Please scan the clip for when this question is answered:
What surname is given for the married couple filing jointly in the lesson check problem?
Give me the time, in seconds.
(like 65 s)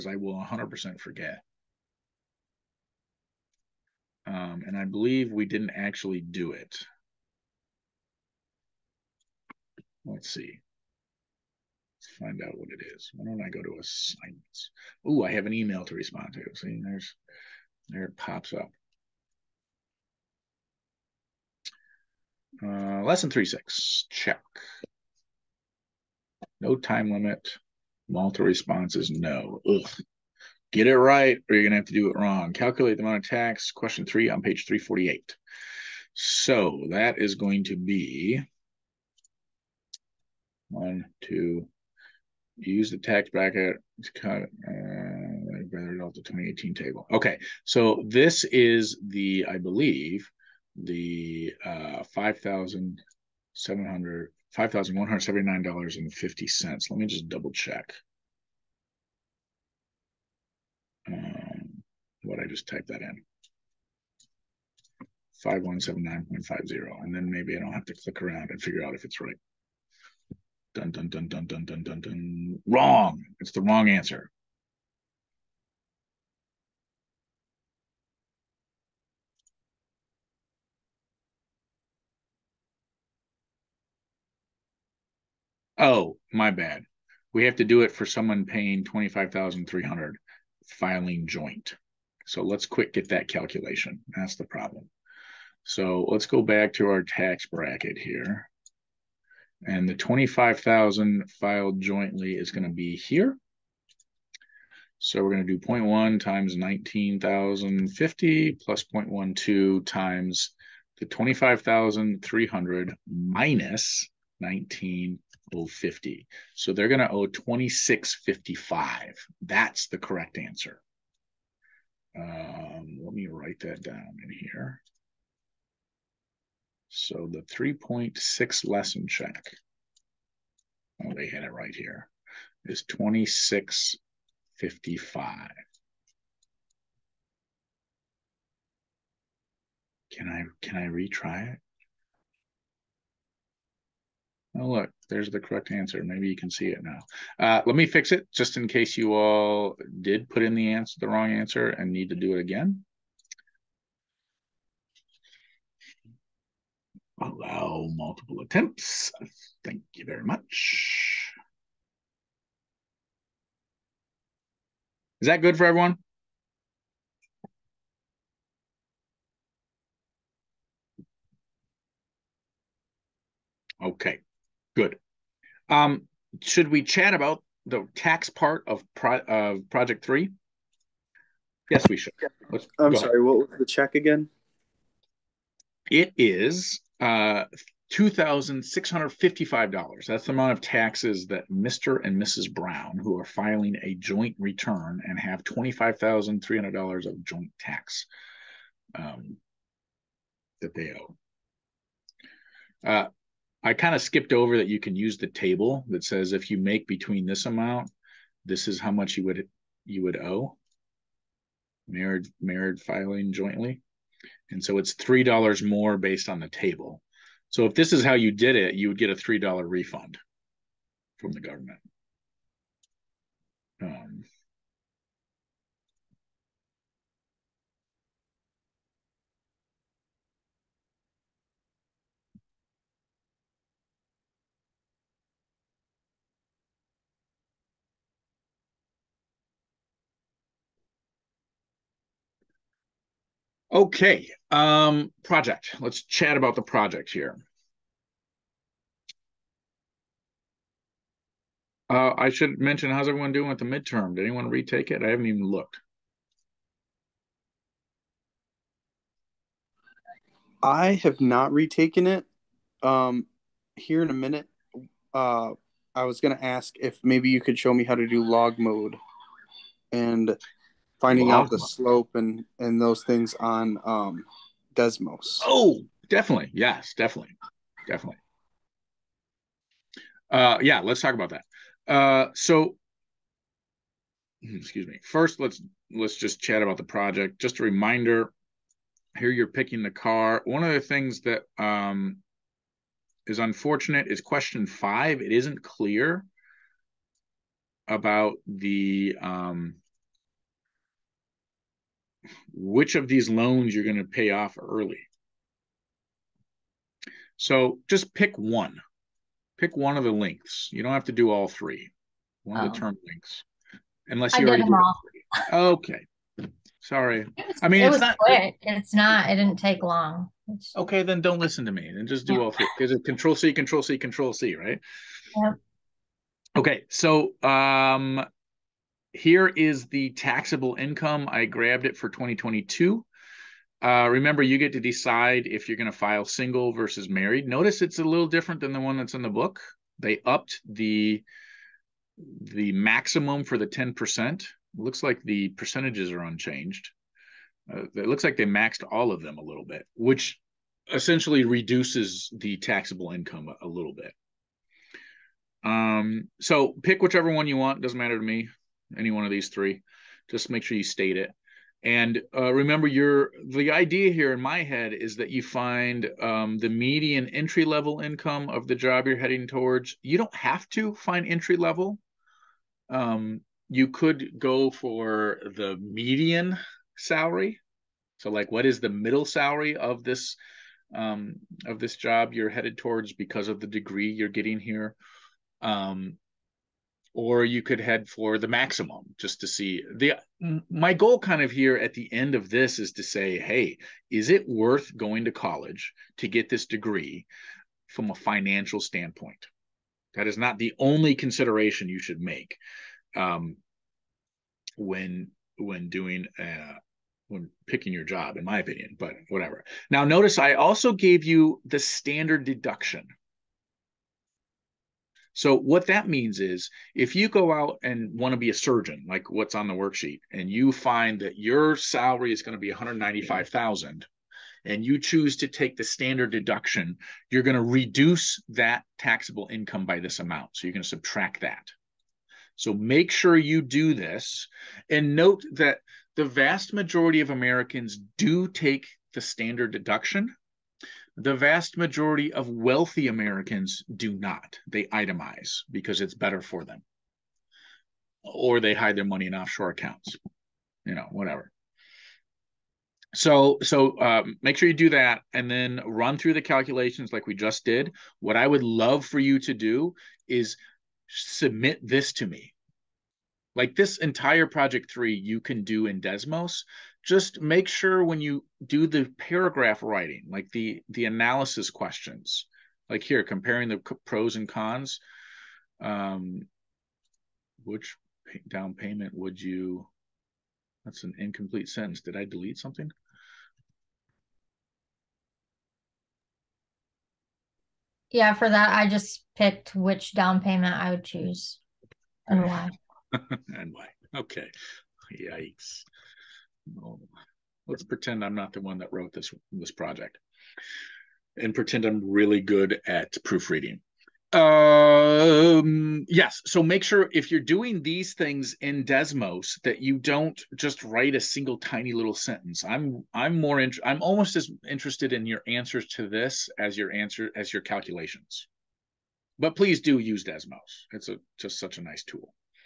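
192 s.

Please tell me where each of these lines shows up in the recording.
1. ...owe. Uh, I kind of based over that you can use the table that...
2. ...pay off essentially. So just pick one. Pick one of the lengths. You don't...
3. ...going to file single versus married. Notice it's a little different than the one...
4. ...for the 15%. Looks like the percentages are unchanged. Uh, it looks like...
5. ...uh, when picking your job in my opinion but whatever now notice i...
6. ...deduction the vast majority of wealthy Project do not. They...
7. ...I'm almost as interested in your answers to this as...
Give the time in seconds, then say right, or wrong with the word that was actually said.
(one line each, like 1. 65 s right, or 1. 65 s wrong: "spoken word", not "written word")
1. 200 s wrong: "skipped", not "based"
2. 304 s wrong: "early", not "essentially"
3. 335 s right
4. 343 s wrong: "10", not "15"
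5. 406 s right
6. 439 s wrong: "Americans", not "Project"
7. 513 s right.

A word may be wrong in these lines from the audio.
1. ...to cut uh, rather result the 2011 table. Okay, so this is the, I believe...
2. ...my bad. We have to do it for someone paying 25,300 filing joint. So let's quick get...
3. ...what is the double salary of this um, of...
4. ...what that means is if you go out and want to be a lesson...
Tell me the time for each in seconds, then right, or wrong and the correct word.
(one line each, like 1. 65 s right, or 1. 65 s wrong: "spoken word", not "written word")
1. 44 s wrong: "2018", not "2011"
2. 86 s right
3. 378 s wrong: "middle", not "double"
4. 415 s wrong: "surgeon", not "lesson".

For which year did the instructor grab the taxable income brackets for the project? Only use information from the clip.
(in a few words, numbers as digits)
2022.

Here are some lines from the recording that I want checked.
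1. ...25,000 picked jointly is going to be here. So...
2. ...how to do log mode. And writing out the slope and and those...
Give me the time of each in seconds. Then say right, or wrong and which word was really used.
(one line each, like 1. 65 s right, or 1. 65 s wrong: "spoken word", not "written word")
1. 99 s wrong: "filed", not "picked"
2. 267 s wrong: "finding", not "writing".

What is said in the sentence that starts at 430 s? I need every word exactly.
So you're going to subtract that.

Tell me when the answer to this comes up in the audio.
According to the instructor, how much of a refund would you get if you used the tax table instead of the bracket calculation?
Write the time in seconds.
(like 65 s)
219 s.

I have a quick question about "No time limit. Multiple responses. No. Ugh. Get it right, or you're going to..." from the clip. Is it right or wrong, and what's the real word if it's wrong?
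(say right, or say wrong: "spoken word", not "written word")
right.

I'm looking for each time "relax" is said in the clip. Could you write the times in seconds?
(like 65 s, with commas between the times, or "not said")
not said.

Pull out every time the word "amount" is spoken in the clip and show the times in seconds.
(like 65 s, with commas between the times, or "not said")
33 s, 190 s, 207 s, 430 s.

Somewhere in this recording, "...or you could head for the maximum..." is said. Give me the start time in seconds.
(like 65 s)
387 s.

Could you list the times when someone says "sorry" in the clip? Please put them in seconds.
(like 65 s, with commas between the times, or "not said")
182 s, 316 s.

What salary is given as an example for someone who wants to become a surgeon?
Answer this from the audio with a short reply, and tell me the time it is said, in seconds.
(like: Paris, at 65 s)
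$195,000, at 422 s.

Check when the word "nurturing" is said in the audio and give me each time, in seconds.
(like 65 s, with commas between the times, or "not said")
not said.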